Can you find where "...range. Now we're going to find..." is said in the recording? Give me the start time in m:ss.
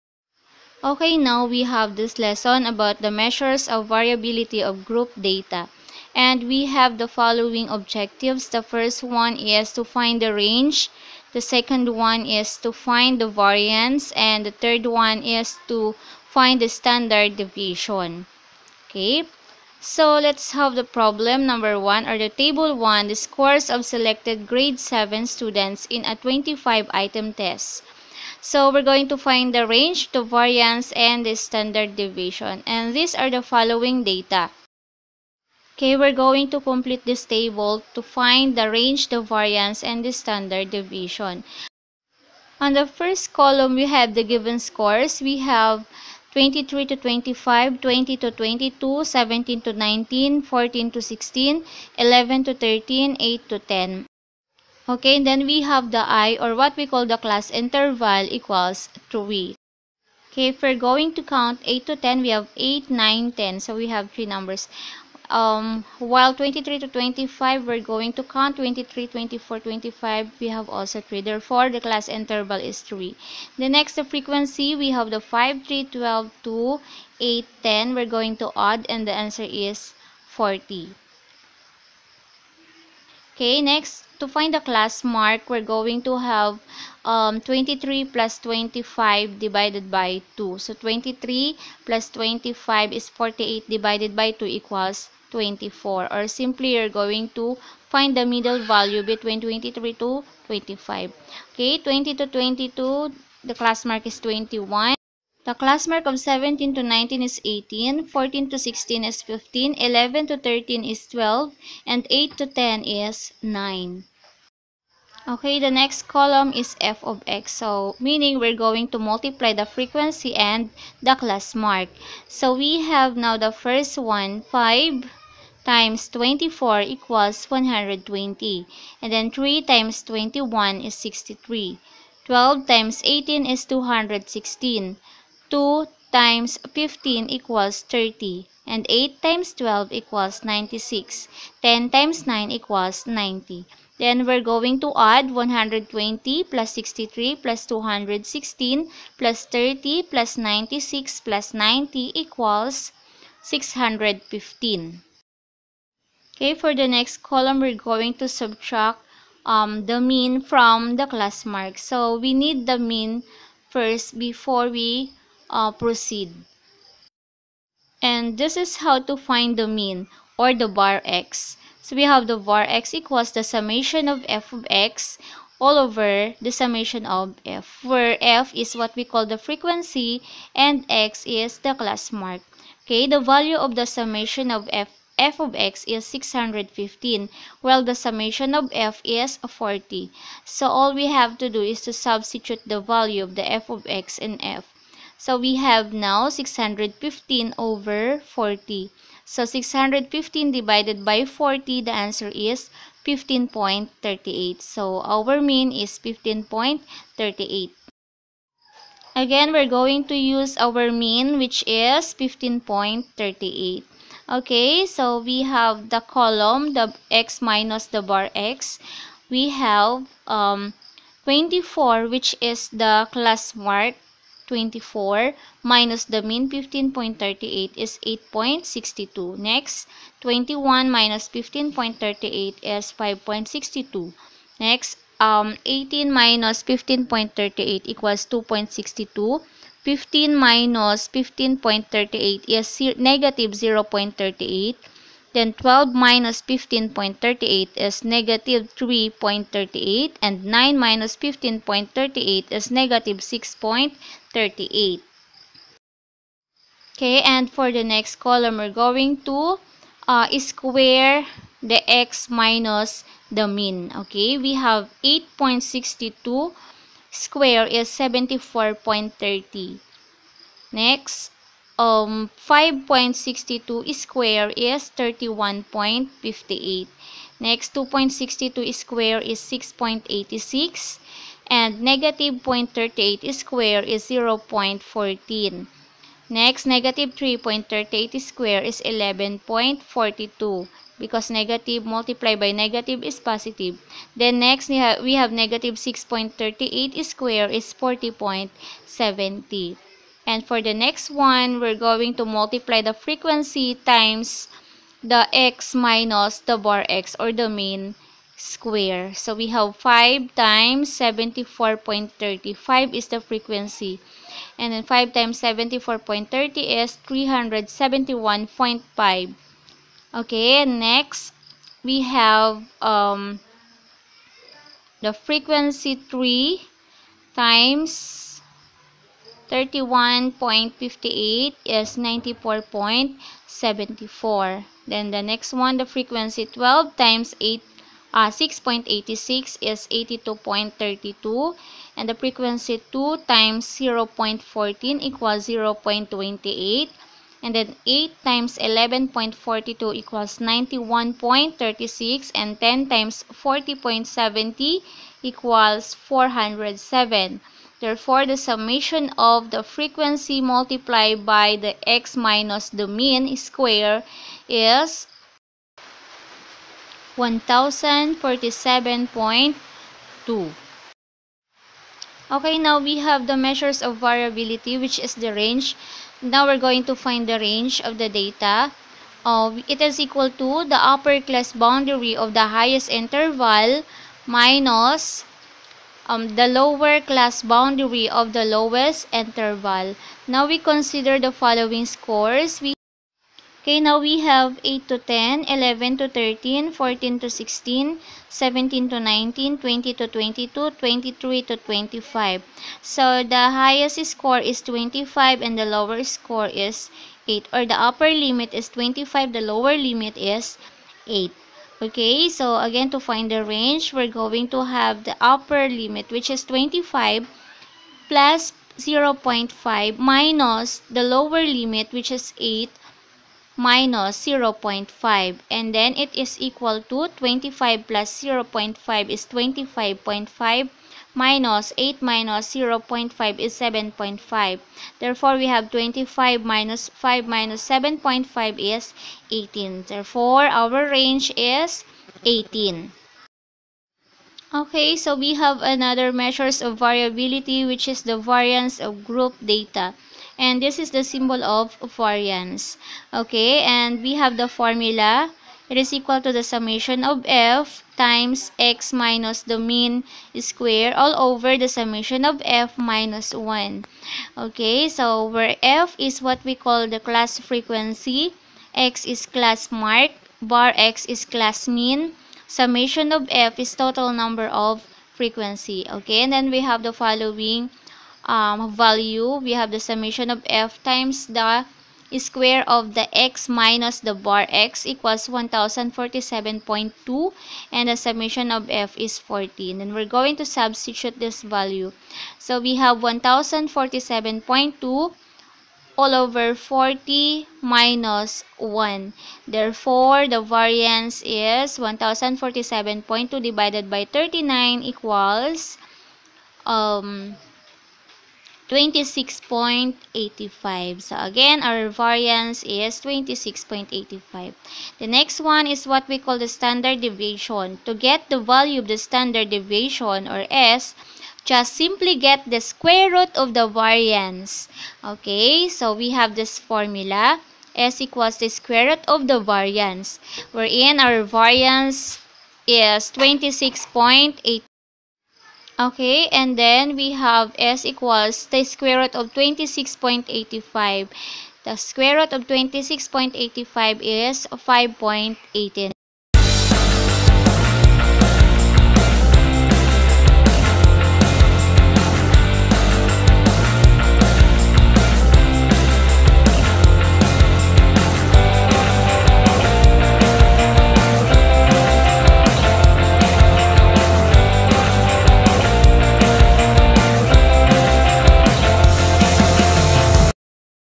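6:15.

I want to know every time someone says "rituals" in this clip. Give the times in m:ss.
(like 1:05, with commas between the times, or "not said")
not said.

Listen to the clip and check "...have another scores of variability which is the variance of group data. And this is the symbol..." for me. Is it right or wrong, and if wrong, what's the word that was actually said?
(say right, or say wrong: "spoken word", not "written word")
wrong: "measures", not "scores".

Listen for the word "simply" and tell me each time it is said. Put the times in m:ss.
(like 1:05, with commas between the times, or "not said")
1:36, 8:41.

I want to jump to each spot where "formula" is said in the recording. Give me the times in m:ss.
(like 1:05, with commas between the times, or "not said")
7:34, 8:46.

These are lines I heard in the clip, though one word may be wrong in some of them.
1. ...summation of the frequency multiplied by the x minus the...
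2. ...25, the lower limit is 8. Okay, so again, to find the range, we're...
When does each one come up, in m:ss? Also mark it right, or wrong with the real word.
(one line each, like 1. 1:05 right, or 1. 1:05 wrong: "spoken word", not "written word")
1. 5:58 right
2. 6:48 right.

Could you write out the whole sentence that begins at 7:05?
And then it is equal to 25 plus 0.5 is 25.5 minus 8 minus 0.5 is 7.5.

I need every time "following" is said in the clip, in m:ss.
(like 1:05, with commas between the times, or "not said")
0:07, 0:33, 6:31, 7:56.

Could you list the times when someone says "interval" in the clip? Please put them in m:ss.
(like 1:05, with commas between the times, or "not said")
0:57, 1:12, 6:22, 6:29.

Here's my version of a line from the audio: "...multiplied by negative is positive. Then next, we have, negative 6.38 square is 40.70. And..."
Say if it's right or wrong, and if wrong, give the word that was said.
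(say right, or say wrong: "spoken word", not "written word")
right.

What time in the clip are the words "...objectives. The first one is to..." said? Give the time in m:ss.
0:07.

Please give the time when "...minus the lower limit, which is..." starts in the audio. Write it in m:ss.
6:59.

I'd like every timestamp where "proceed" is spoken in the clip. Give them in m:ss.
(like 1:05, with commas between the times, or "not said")
2:45.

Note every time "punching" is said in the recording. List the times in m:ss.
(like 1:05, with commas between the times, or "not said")
not said.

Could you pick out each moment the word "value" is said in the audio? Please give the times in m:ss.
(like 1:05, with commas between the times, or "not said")
1:38, 3:03, 3:12, 7:58, 8:11, 8:38.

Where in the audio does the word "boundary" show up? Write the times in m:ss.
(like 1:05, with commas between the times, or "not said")
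6:21, 6:27.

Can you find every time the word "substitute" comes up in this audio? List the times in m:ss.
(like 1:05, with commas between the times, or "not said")
3:11, 8:10.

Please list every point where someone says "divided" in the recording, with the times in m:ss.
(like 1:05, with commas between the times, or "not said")
1:29, 1:33, 3:20, 8:23.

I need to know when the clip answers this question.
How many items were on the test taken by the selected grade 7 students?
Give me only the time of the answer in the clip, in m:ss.
0:26.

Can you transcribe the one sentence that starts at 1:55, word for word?
Okay, the next column is f of x.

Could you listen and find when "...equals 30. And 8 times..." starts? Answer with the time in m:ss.
2:17.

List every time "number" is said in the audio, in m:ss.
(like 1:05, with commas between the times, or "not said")
0:21, 1:04, 7:54.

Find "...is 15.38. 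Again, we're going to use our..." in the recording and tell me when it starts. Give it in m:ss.
3:25.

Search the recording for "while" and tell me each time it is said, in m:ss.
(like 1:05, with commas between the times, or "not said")
1:05, 3:07.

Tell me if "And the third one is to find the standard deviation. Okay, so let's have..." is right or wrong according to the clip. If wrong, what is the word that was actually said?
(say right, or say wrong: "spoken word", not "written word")
right.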